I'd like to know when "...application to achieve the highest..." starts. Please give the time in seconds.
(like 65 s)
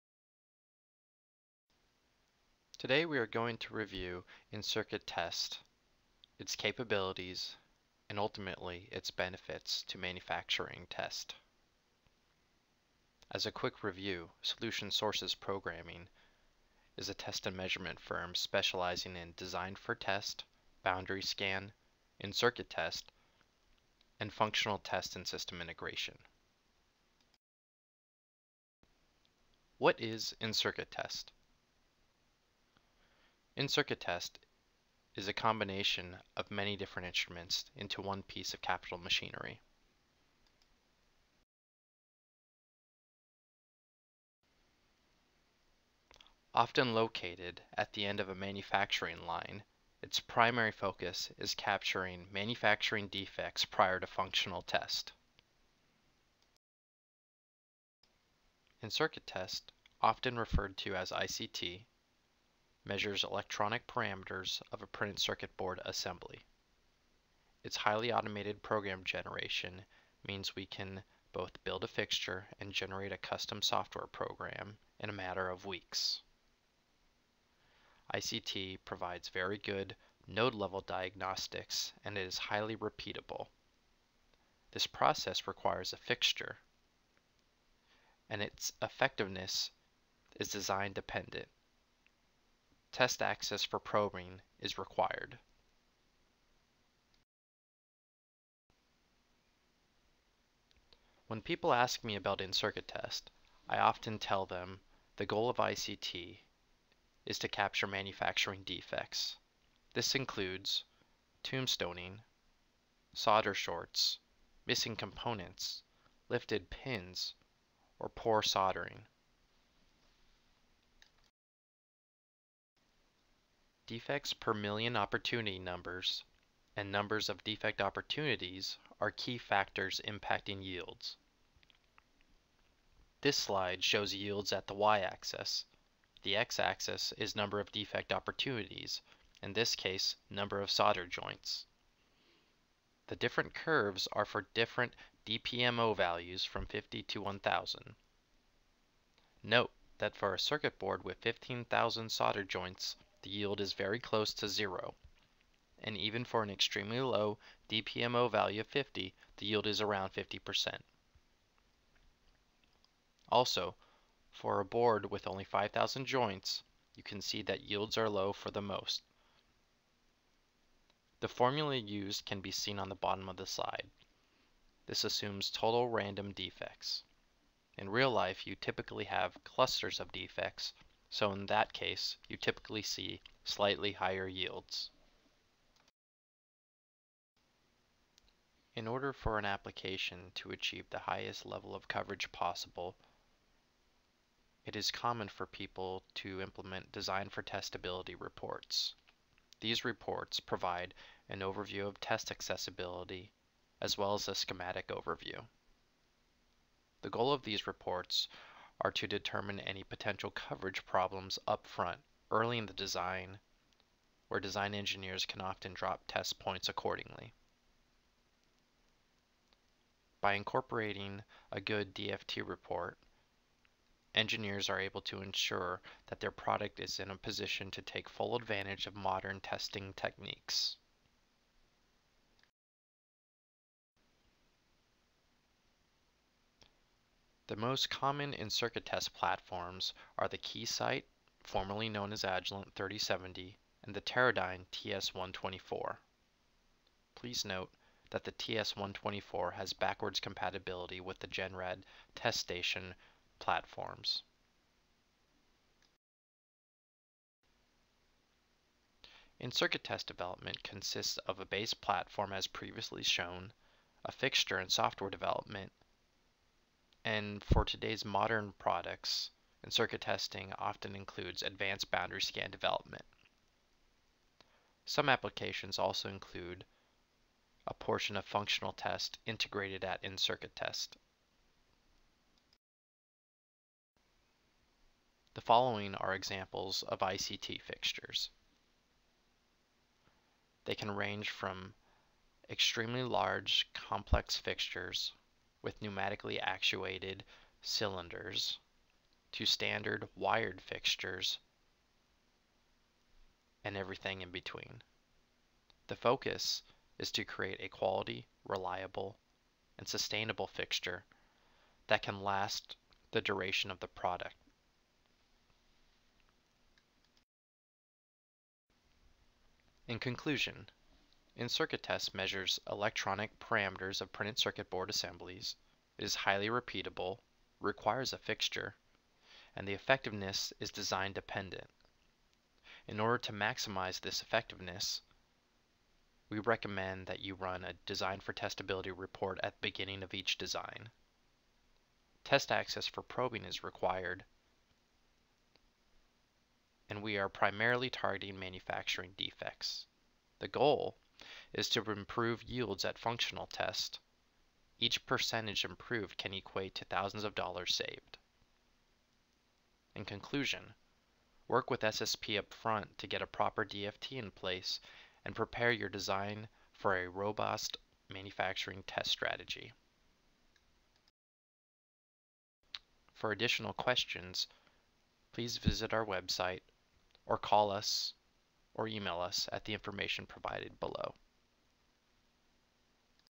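189 s.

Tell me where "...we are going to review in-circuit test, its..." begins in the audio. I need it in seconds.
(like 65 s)
3 s.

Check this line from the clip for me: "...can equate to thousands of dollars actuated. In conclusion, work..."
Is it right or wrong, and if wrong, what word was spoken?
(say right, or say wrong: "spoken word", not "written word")
wrong: "saved", not "actuated".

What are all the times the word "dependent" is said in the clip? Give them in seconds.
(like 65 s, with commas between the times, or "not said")
90 s, 331 s.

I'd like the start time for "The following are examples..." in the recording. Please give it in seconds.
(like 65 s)
285 s.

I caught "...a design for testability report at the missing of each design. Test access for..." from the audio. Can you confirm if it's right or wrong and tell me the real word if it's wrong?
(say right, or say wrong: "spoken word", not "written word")
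wrong: "beginning", not "missing".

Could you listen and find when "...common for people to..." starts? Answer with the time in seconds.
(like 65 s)
194 s.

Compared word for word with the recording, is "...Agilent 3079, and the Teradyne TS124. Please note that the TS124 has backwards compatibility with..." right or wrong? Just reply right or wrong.
wrong.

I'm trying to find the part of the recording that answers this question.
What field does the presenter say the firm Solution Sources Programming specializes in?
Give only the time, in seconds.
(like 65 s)
17 s.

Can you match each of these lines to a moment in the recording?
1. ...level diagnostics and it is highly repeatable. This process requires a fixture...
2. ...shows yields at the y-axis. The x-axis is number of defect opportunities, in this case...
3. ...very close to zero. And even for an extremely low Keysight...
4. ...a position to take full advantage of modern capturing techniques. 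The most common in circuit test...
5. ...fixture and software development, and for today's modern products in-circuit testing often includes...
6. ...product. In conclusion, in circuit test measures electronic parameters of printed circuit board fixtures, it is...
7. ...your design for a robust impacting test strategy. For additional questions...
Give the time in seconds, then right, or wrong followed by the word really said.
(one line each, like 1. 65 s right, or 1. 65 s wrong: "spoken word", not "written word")
1. 80 s right
2. 133 s right
3. 153 s wrong: "DPMO", not "Keysight"
4. 227 s wrong: "testing", not "capturing"
5. 264 s right
6. 313 s wrong: "assemblies", not "fixtures"
7. 365 s wrong: "manufacturing", not "impacting".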